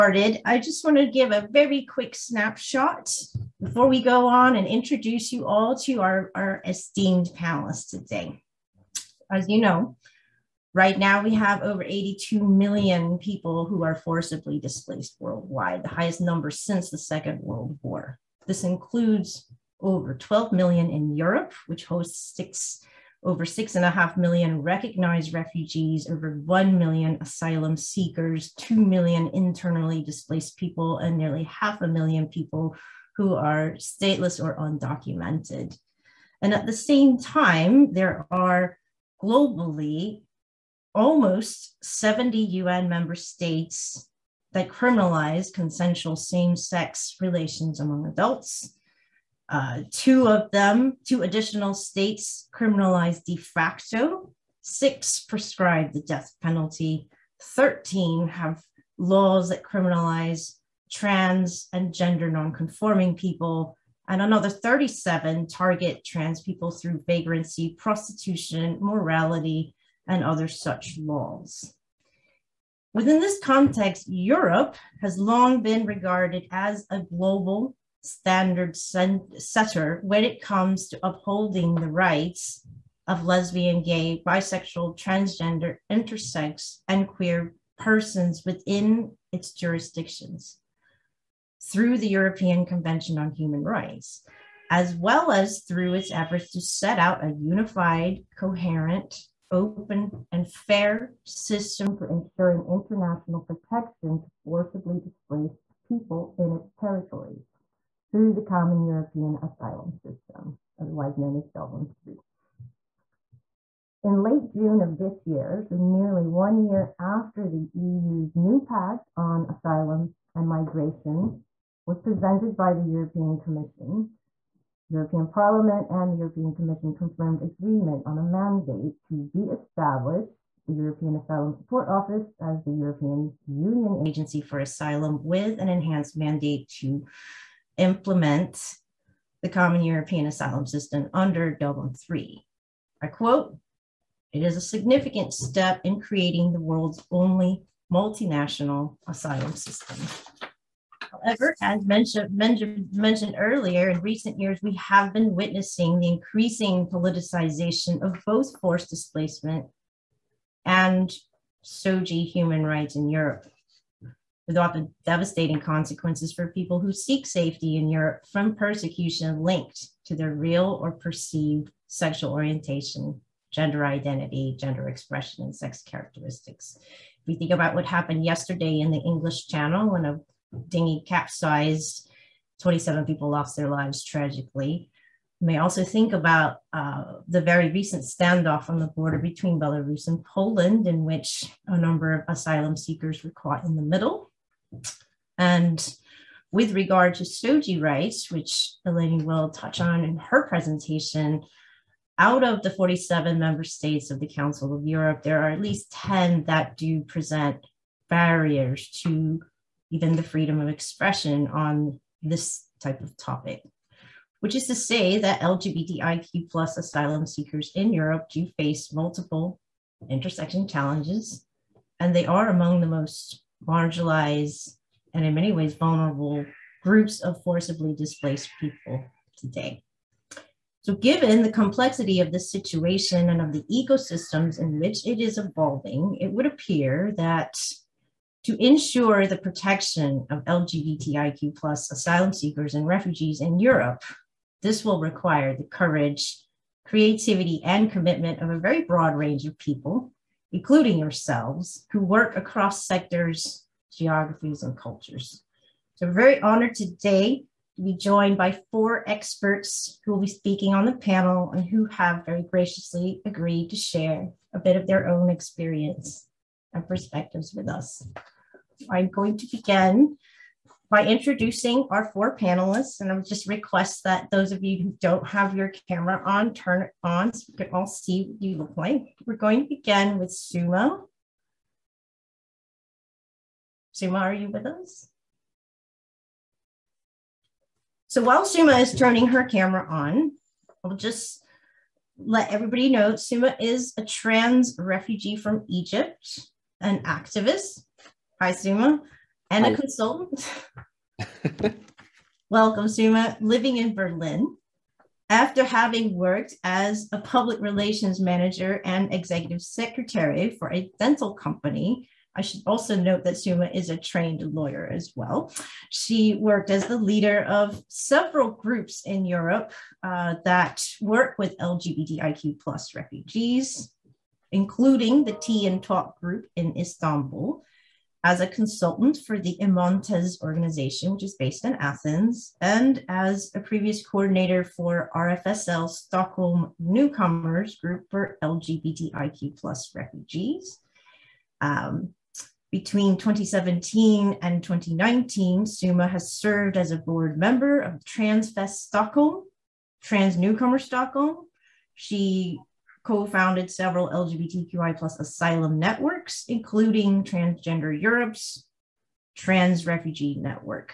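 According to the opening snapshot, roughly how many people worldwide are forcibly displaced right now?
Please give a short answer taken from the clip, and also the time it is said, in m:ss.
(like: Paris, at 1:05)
over 82 million, at 0:11.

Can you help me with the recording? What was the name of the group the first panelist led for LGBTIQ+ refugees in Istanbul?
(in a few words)
Tea and Talk.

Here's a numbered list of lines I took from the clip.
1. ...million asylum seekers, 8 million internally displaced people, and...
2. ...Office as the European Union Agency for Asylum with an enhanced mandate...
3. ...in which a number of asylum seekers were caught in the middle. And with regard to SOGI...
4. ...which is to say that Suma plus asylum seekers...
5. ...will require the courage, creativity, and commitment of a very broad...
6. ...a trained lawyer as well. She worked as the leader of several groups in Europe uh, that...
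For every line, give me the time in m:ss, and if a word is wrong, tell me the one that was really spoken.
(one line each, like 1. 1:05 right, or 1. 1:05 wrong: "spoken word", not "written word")
1. 0:26 wrong: "2", not "8"
2. 2:11 right
3. 3:10 right
4. 3:34 wrong: "LGBTIQ", not "Suma"
5. 4:04 right
6. 5:13 right.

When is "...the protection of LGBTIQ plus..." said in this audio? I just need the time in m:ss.
3:59.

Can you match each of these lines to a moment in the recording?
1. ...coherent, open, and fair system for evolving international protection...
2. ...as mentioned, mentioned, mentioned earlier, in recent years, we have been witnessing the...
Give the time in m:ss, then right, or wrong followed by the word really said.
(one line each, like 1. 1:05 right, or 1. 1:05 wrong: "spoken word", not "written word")
1. 1:38 wrong: "ensuring", not "evolving"
2. 2:31 right.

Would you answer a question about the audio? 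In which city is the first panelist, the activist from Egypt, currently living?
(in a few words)
Berlin.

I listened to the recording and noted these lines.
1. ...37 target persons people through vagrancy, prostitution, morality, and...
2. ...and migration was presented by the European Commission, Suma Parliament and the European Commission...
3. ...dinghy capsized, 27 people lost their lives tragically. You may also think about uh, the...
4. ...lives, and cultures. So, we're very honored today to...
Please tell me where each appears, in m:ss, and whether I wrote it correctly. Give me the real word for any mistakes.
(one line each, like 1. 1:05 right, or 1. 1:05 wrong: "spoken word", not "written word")
1. 1:04 wrong: "trans", not "persons"
2. 2:00 wrong: "European", not "Suma"
3. 3:00 right
4. 4:13 wrong: "geographies", not "lives".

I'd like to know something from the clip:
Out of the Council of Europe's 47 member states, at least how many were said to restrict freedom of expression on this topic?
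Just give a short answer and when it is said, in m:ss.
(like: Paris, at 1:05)
10, at 3:25.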